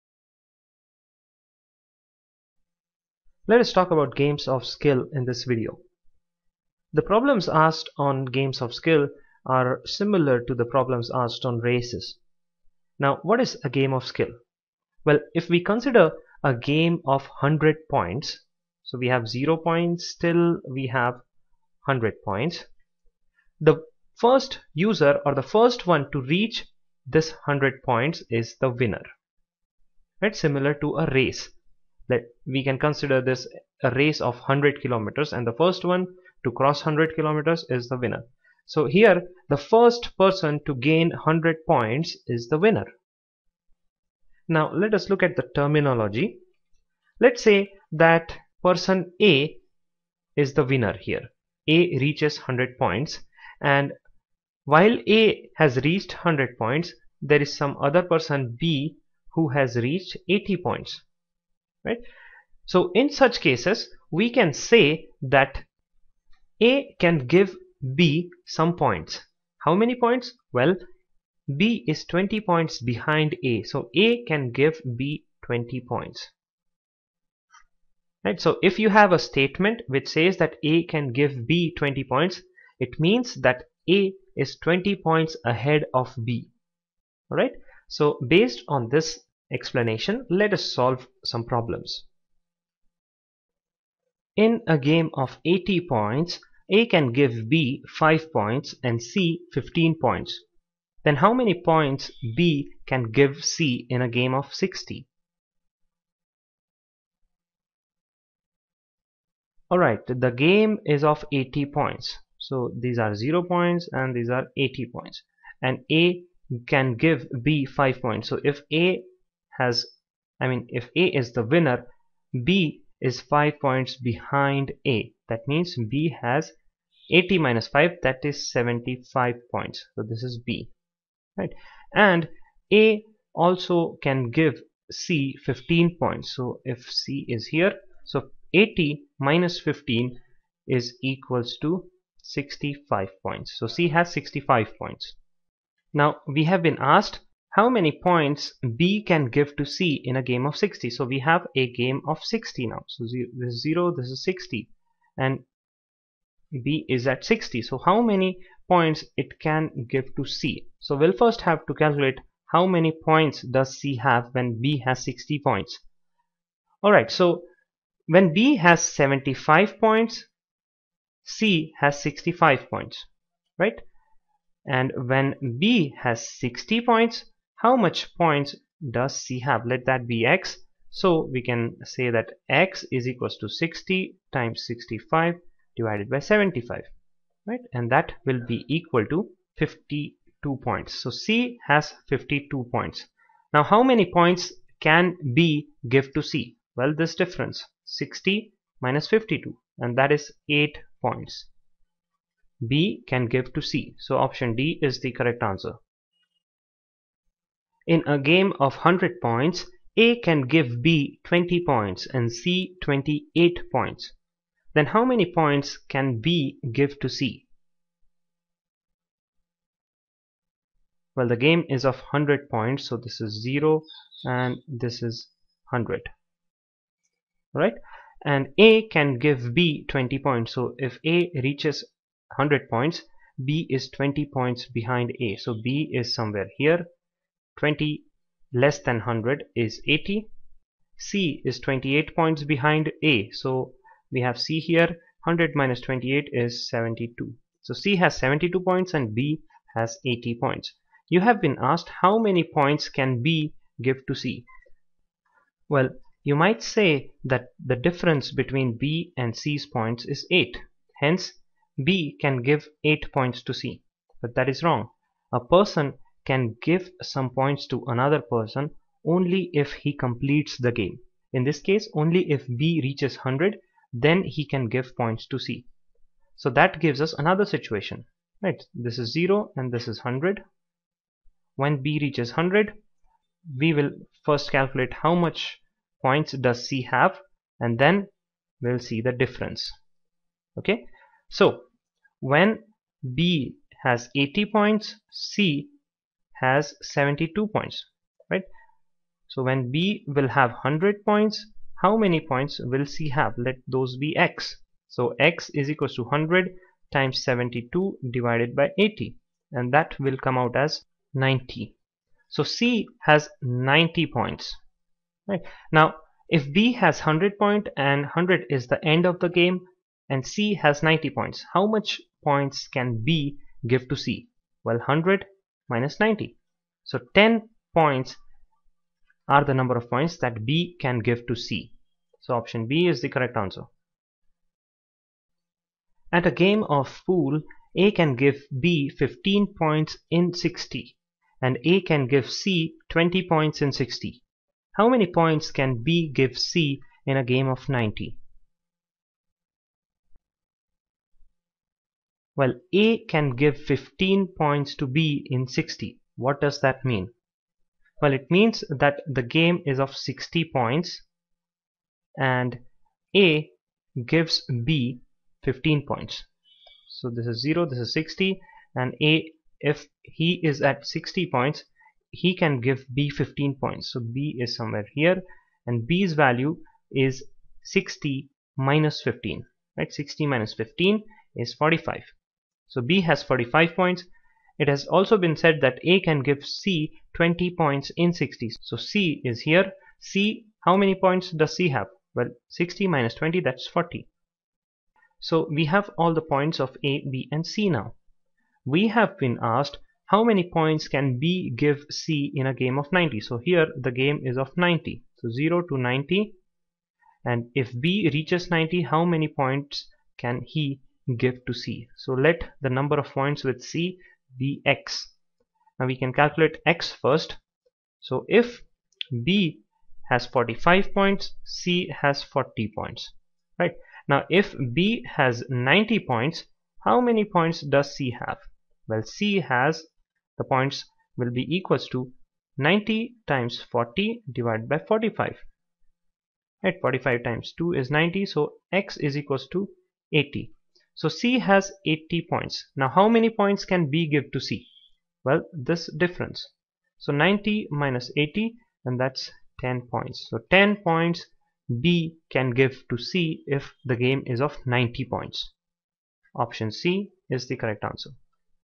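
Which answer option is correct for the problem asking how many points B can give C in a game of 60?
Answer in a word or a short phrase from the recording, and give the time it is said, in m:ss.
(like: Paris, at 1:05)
D, at 3:24.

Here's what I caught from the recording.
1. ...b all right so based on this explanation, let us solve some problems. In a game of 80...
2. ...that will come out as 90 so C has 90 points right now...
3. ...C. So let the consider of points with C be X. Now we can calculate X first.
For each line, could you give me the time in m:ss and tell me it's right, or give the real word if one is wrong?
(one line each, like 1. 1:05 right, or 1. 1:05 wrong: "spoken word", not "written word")
1. 1:26 right
2. 5:09 right
3. 6:51 wrong: "number", not "consider".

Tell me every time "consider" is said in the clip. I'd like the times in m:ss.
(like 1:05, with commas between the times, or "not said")
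0:15, 0:32.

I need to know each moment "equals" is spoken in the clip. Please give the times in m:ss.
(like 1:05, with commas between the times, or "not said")
2:21, 3:03, 3:08, 5:05, 7:11, 7:19.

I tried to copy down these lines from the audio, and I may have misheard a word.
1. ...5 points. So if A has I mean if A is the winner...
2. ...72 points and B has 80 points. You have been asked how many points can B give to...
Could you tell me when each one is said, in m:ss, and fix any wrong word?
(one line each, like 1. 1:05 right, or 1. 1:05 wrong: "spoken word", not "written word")
1. 1:57 right
2. 4:08 right.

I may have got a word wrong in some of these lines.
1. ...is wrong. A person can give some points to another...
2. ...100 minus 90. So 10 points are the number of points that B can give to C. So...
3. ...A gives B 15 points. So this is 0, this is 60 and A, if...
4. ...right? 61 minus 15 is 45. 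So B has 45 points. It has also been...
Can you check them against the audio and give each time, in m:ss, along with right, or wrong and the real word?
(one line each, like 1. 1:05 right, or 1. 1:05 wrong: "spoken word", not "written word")
1. 4:24 right
2. 5:24 right
3. 6:03 right
4. 6:19 wrong: "60", not "61".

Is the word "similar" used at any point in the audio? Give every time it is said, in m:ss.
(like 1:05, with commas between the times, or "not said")
0:09, 0:30.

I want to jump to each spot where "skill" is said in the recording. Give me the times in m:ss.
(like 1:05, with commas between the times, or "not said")
0:04, 0:08, 0:14.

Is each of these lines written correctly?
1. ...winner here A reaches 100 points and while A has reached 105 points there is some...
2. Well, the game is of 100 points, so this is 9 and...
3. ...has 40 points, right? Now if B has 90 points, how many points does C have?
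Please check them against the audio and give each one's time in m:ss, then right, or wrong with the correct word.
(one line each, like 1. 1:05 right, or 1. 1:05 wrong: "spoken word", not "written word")
1. 0:50 wrong: "100", not "105"
2. 3:41 wrong: "0", not "9"
3. 7:02 right.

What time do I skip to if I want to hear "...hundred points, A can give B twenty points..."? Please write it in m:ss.
3:28.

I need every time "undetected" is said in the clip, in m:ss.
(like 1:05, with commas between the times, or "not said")
not said.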